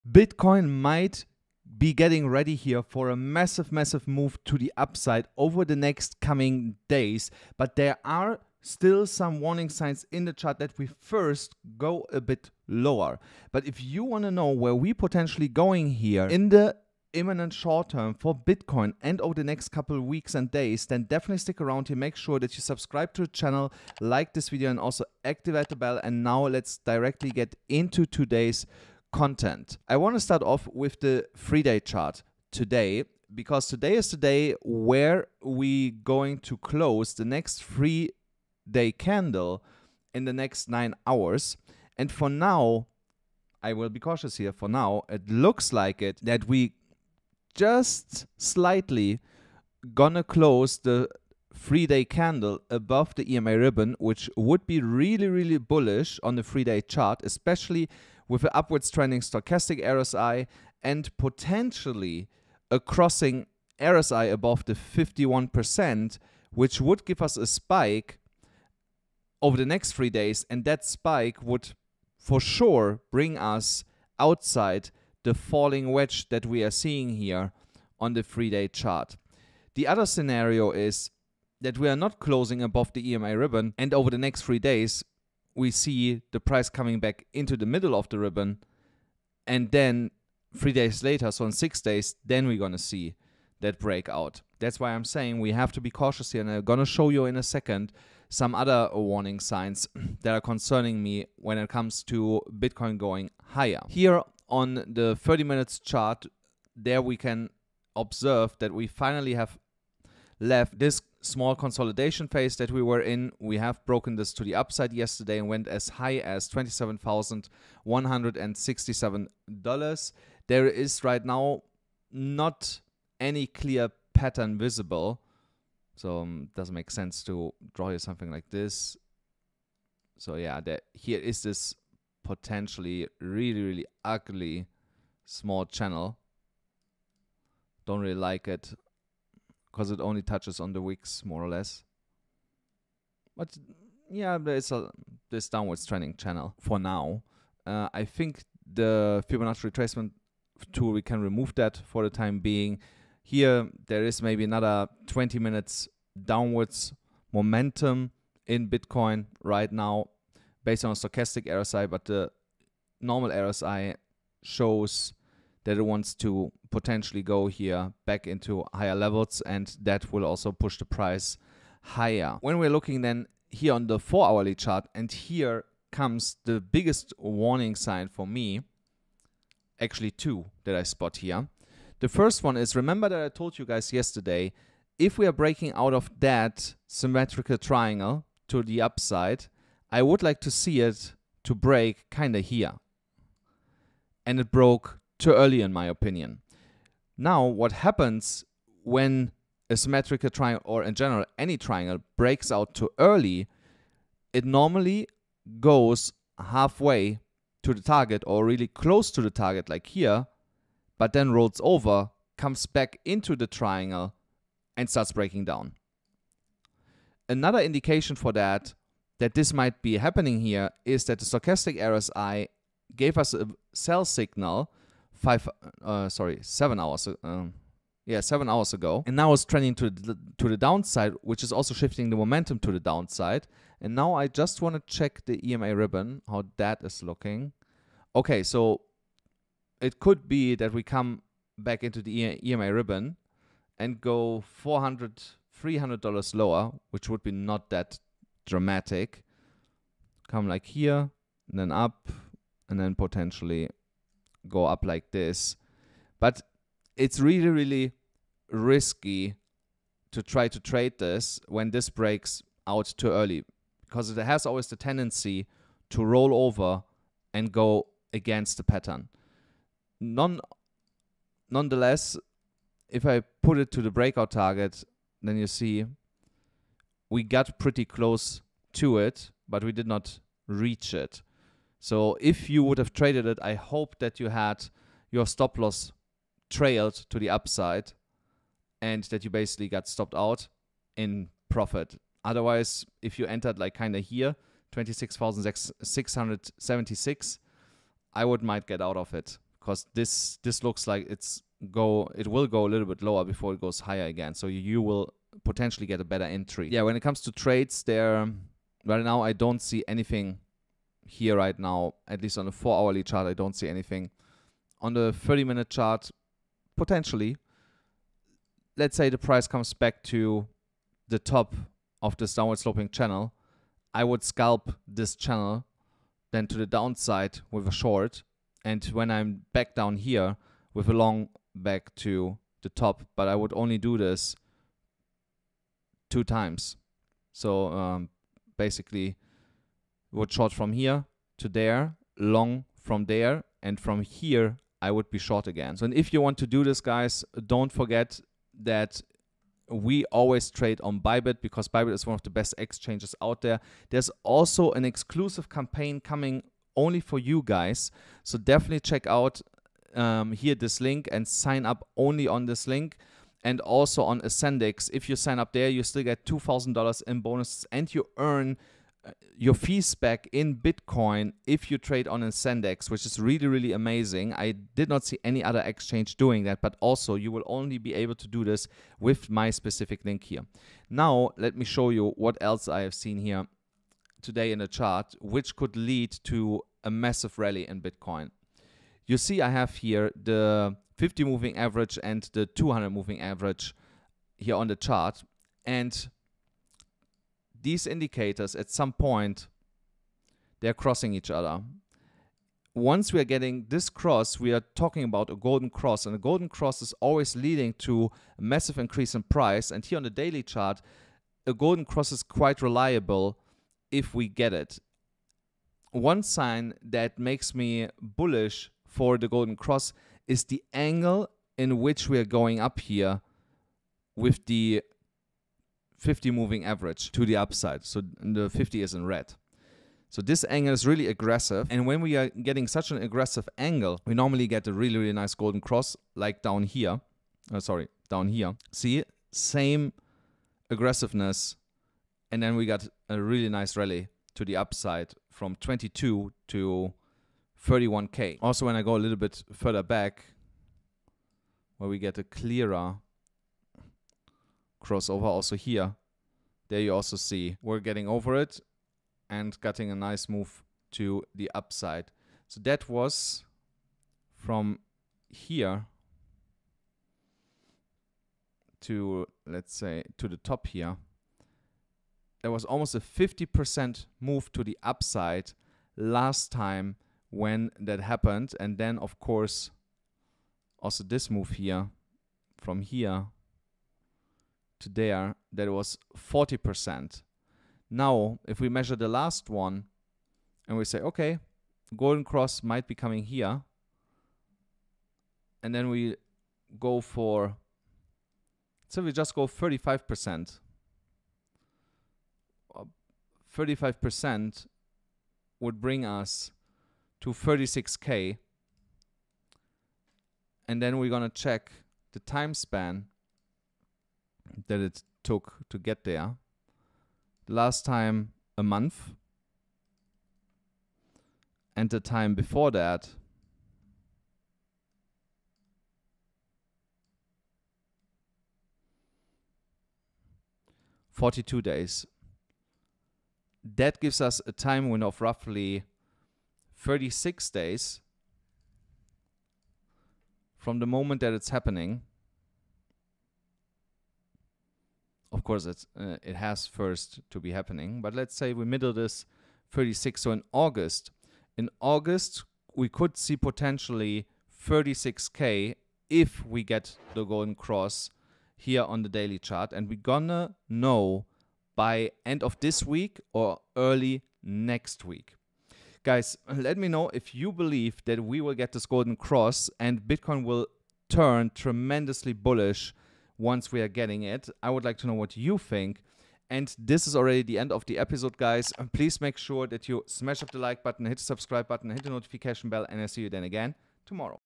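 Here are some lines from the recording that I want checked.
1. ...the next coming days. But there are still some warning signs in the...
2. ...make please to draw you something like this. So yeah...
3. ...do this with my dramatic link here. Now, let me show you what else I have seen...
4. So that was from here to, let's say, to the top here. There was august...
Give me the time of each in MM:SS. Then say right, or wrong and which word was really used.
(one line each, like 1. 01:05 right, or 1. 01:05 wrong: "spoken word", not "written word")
1. 00:05 right
2. 02:06 wrong: "sense", not "please"
3. 06:18 wrong: "specific", not "dramatic"
4. 07:42 wrong: "almost", not "august".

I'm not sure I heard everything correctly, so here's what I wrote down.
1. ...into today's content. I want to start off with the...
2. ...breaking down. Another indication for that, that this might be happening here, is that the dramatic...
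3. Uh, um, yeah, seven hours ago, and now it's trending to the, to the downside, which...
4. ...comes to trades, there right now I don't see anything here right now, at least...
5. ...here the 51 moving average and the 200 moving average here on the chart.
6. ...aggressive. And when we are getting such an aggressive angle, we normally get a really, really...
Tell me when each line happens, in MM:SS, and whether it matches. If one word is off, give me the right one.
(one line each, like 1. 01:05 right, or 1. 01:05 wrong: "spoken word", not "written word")
1. 00:27 right
2. 03:35 wrong: "stochastic", not "dramatic"
3. 03:47 right
4. 05:06 right
5. 06:29 wrong: "50", not "51"
6. 07:11 right.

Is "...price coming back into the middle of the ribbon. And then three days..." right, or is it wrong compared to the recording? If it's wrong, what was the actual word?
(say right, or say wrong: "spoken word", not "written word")
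right.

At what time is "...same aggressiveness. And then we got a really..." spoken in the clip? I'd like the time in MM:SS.
07:19.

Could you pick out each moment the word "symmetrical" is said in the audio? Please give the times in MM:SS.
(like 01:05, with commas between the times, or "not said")
03:06, 03:19.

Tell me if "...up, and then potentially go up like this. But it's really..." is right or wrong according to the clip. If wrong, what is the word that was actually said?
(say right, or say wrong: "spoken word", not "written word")
right.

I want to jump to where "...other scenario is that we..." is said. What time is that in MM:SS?
01:19.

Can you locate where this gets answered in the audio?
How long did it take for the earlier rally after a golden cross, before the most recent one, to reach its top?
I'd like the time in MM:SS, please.
08:51.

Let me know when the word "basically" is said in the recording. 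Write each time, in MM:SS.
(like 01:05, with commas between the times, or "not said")
04:49, 05:38.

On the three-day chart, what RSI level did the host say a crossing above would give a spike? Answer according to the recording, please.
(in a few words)
51%.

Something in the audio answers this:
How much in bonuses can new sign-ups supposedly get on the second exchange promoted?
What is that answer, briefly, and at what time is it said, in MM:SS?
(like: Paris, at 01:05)
$2,000, at 06:06.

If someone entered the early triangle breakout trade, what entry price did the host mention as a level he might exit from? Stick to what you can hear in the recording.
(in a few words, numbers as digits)
26,676.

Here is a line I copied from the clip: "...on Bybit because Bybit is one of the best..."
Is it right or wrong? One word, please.
right.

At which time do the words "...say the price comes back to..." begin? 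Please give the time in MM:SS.
05:18.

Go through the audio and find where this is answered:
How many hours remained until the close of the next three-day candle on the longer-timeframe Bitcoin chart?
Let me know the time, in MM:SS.
00:40.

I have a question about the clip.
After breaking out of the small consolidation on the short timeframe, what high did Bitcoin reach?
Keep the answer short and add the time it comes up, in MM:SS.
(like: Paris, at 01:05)
$27,167, at 01:56.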